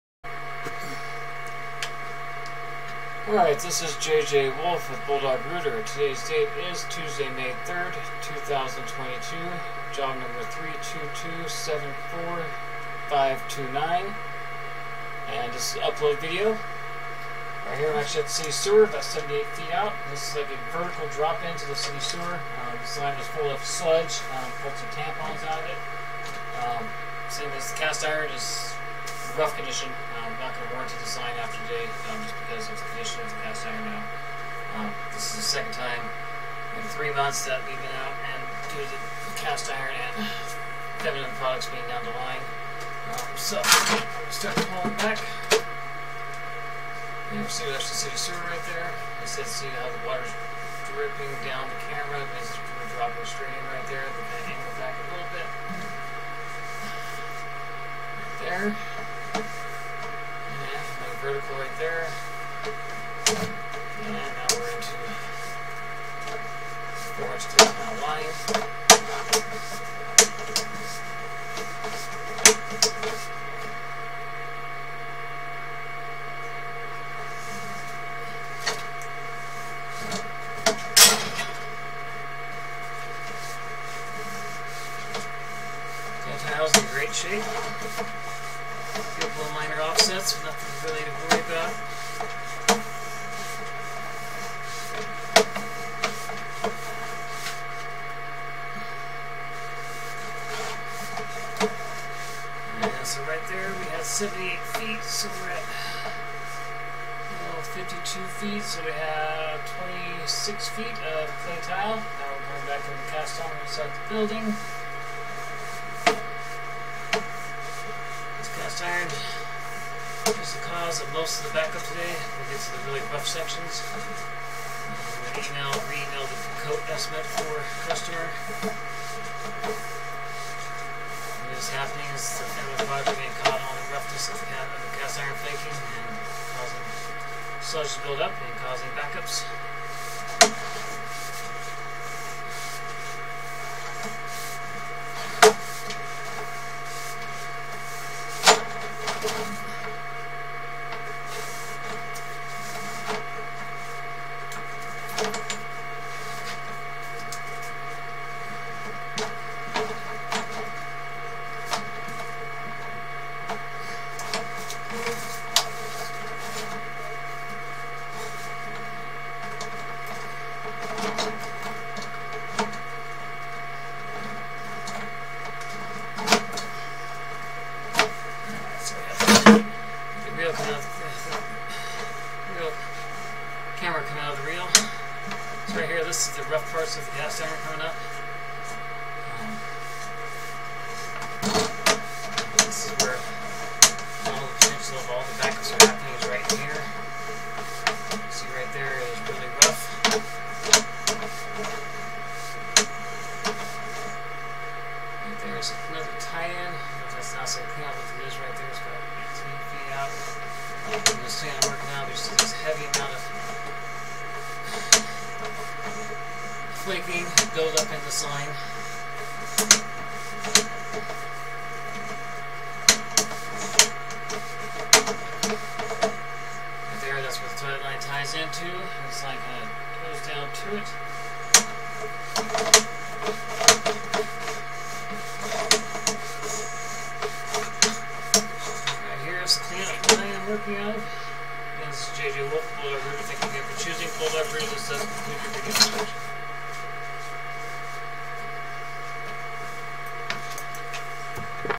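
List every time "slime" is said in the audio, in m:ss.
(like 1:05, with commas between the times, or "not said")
3:38, 3:49.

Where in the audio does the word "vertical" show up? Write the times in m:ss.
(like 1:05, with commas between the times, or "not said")
0:20, 1:01.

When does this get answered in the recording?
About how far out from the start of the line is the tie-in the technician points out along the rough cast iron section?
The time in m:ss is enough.
3:29.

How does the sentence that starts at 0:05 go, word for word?
Today's date is Tuesday, May 3rd, 2022.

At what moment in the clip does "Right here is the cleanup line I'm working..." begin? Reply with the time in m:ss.
3:59.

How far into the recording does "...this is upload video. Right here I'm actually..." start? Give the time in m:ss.
0:15.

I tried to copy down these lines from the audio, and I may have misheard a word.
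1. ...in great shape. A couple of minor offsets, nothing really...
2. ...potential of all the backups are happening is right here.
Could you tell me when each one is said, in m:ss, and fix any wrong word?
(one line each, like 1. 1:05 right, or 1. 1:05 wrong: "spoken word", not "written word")
1. 1:26 right
2. 3:14 right.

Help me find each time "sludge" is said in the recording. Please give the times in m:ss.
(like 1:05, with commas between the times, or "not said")
0:23, 2:17.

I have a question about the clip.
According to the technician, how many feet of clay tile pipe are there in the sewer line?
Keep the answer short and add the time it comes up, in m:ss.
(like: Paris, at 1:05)
26 feet, at 1:50.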